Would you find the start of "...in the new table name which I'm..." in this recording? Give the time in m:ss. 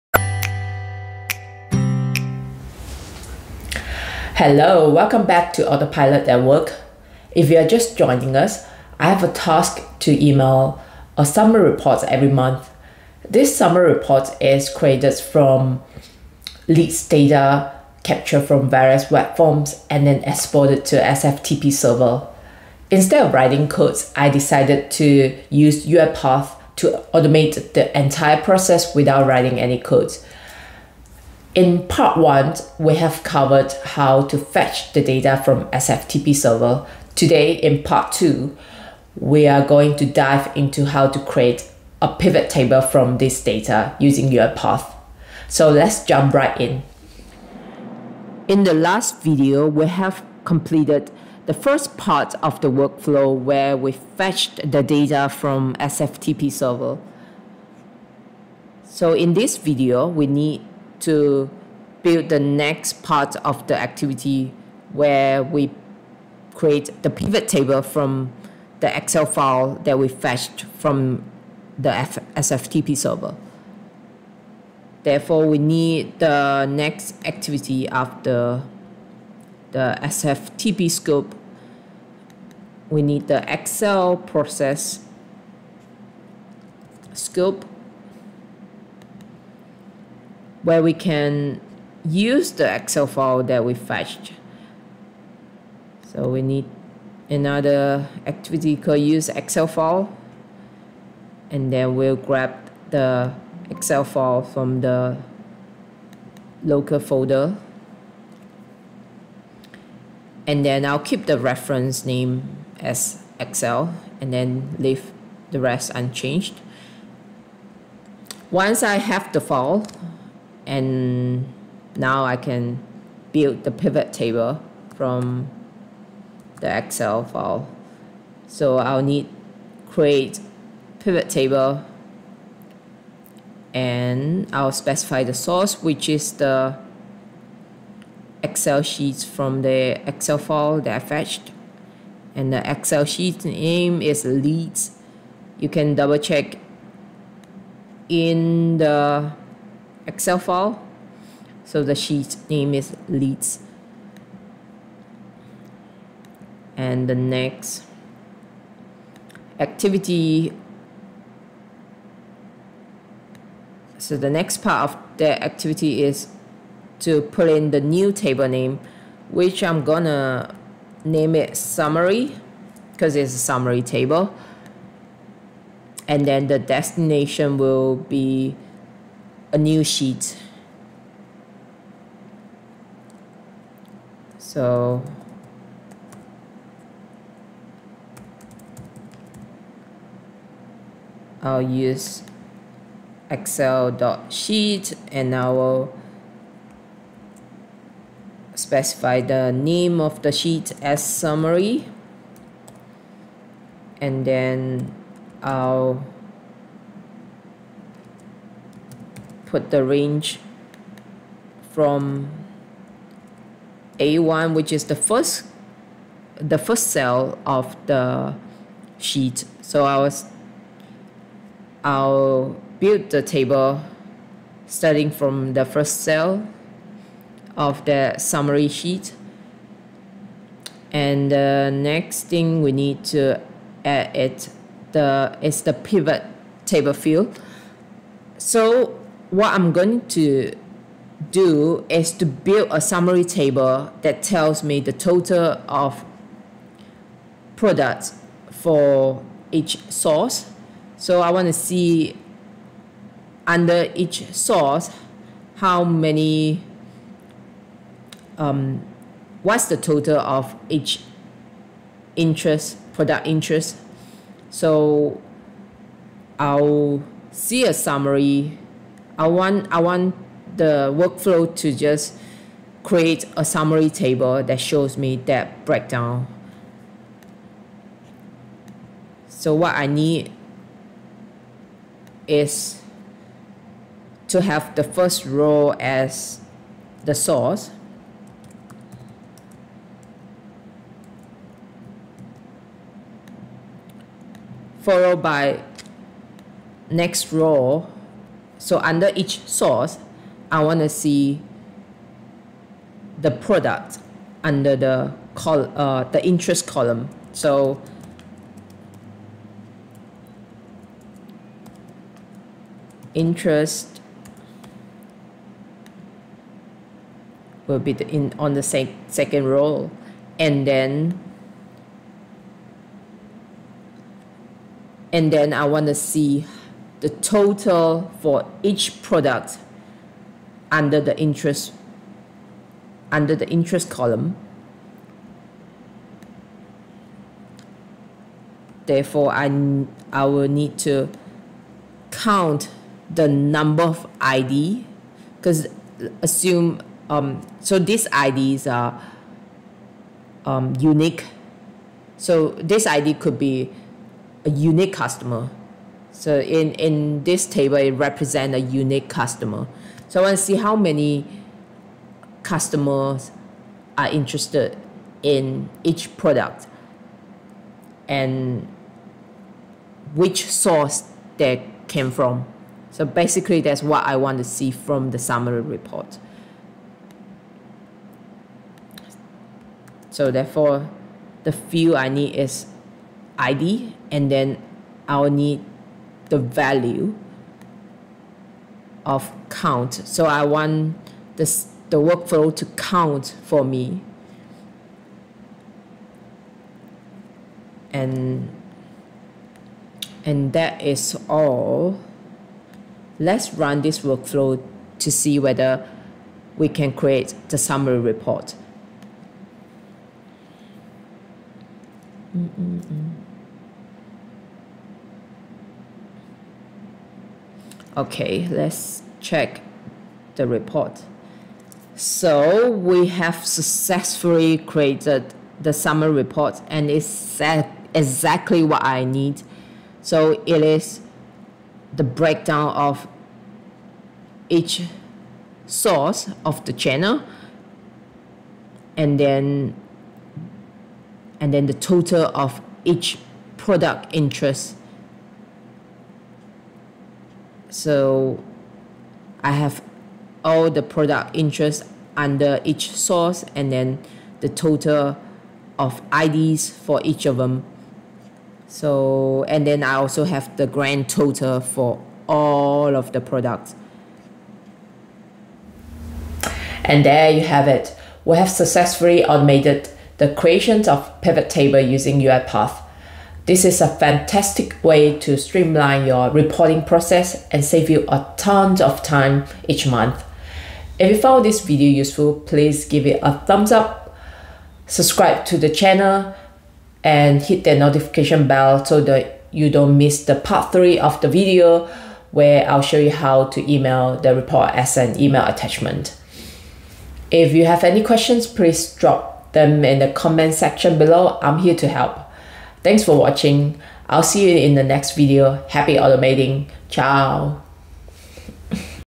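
2:47.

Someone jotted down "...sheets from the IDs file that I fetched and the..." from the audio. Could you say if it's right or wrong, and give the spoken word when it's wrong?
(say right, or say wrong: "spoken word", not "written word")
wrong: "Excel", not "IDs".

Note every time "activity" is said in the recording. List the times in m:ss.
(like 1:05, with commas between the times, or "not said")
1:03, 1:17, 1:38, 2:39, 2:45.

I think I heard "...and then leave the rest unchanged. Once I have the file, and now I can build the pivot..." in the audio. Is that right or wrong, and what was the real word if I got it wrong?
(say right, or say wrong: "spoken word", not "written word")
right.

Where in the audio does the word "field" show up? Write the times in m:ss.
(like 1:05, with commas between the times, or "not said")
3:56, 6:21.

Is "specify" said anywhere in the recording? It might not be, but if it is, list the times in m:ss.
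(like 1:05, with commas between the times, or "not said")
2:14, 3:18.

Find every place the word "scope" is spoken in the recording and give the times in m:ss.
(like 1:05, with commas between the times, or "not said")
1:20, 1:27.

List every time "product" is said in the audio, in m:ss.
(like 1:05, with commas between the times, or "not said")
4:07, 4:22, 5:03, 5:29, 6:06, 7:23, 7:30, 7:43.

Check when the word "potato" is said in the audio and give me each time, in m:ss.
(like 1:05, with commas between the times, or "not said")
not said.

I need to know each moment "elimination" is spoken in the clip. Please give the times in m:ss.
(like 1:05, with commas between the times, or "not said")
not said.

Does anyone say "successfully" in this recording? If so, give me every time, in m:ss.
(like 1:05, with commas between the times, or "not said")
7:03, 7:48.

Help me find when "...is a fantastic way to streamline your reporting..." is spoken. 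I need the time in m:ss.
7:53.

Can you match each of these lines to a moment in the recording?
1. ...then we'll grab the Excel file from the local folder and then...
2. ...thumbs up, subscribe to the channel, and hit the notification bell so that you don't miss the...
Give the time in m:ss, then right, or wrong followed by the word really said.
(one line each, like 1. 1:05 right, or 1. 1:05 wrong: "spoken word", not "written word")
1. 1:41 right
2. 8:03 right.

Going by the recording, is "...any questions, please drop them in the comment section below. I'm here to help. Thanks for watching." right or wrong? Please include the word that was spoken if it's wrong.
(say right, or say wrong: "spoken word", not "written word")
right.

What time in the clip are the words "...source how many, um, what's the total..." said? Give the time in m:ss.
4:14.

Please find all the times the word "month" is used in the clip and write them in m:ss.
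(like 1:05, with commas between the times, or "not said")
0:12, 7:59.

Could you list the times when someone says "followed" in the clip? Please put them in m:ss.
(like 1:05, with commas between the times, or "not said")
4:54.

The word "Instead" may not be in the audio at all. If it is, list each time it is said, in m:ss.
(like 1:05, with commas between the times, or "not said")
0:22.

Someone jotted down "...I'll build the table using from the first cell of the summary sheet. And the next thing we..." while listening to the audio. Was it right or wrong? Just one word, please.
wrong.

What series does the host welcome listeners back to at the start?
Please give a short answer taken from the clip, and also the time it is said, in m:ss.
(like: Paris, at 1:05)
Autopilot at Work, at 0:05.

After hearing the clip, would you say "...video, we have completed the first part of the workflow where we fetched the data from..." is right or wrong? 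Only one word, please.
right.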